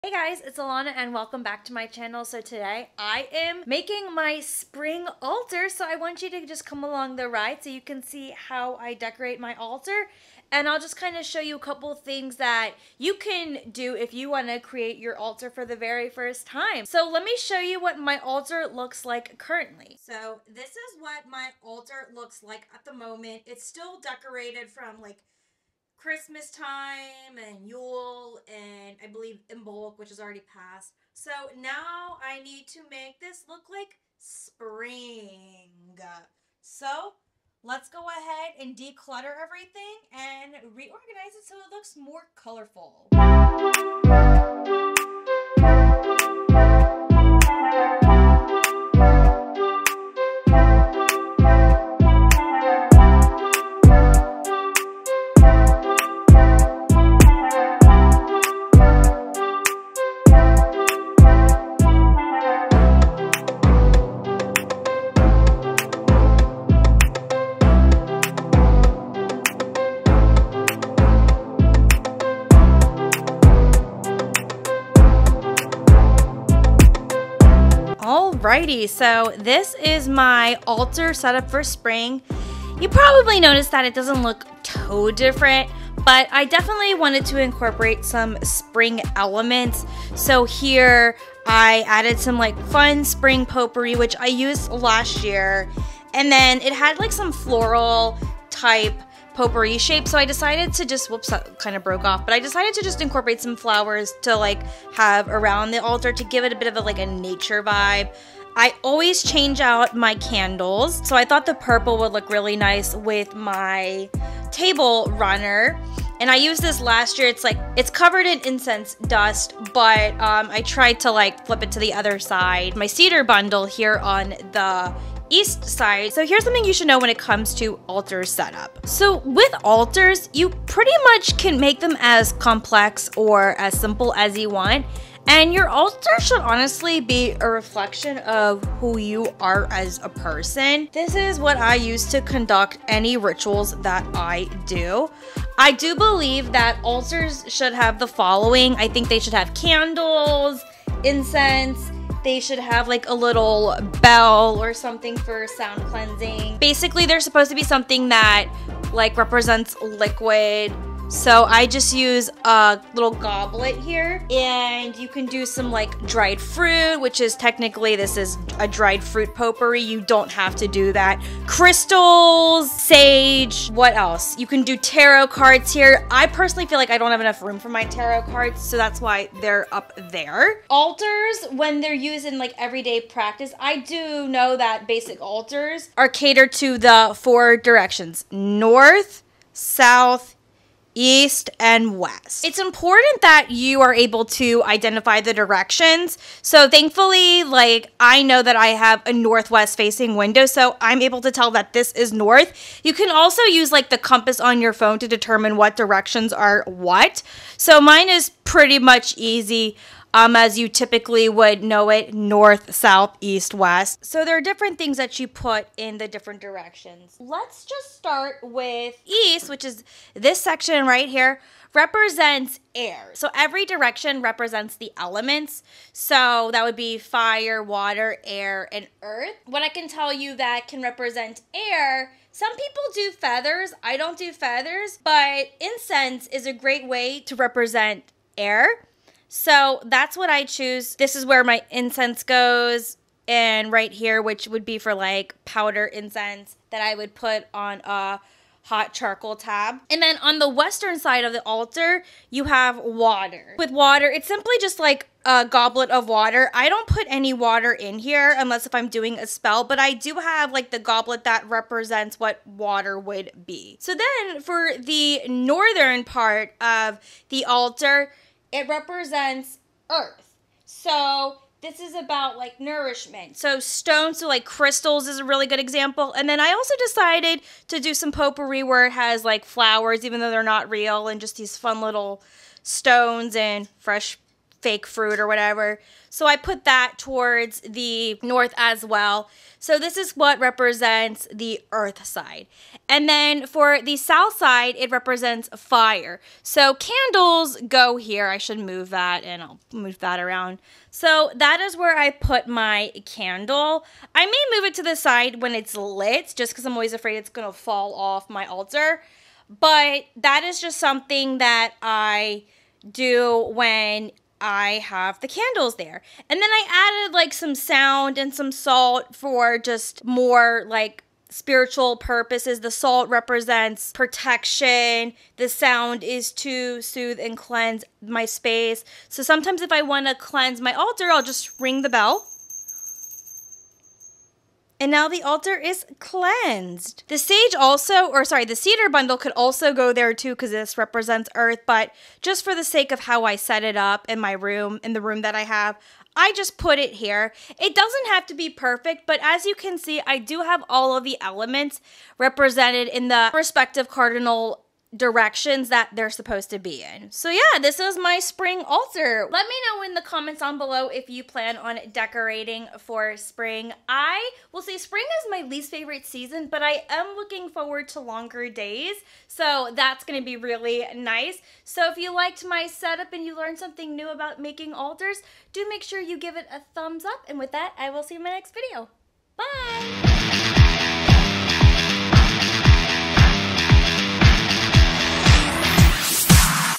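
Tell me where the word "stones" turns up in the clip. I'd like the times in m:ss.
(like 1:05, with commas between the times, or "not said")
4:33, 4:42.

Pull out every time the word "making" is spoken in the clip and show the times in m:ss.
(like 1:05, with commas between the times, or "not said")
0:03, 6:14.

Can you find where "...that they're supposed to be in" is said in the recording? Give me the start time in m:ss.
5:55.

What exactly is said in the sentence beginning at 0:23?
It's still decorated from like Christmas time and Yule and I believe Imbolc, which has already passed.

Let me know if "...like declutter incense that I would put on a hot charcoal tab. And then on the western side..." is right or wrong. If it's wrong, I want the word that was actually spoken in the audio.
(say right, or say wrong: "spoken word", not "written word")
wrong: "powder", not "declutter".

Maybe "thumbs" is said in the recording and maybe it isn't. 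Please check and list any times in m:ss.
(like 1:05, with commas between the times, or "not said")
6:16.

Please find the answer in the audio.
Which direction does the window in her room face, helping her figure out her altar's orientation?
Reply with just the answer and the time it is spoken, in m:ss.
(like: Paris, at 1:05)
Northwest, at 3:19.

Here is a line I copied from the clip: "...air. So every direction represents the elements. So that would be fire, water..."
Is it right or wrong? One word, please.
right.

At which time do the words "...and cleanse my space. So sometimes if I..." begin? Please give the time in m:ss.
5:27.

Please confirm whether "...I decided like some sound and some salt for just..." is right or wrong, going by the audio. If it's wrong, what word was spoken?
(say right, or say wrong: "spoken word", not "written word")
wrong: "added", not "decided".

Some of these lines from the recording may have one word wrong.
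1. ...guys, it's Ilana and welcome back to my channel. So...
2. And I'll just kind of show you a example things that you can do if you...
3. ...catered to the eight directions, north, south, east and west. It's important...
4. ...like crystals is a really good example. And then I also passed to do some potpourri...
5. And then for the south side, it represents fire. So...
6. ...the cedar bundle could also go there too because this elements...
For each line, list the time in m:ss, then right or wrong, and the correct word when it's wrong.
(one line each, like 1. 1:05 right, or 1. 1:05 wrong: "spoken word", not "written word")
1. 0:00 right
2. 0:10 wrong: "couple", not "example"
3. 3:06 wrong: "four", not "eight"
4. 4:34 wrong: "decided", not "passed"
5. 4:52 right
6. 5:38 wrong: "represents", not "elements".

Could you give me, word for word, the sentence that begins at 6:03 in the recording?
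I will say spring is my least favorite season, but I am looking forward to longer days.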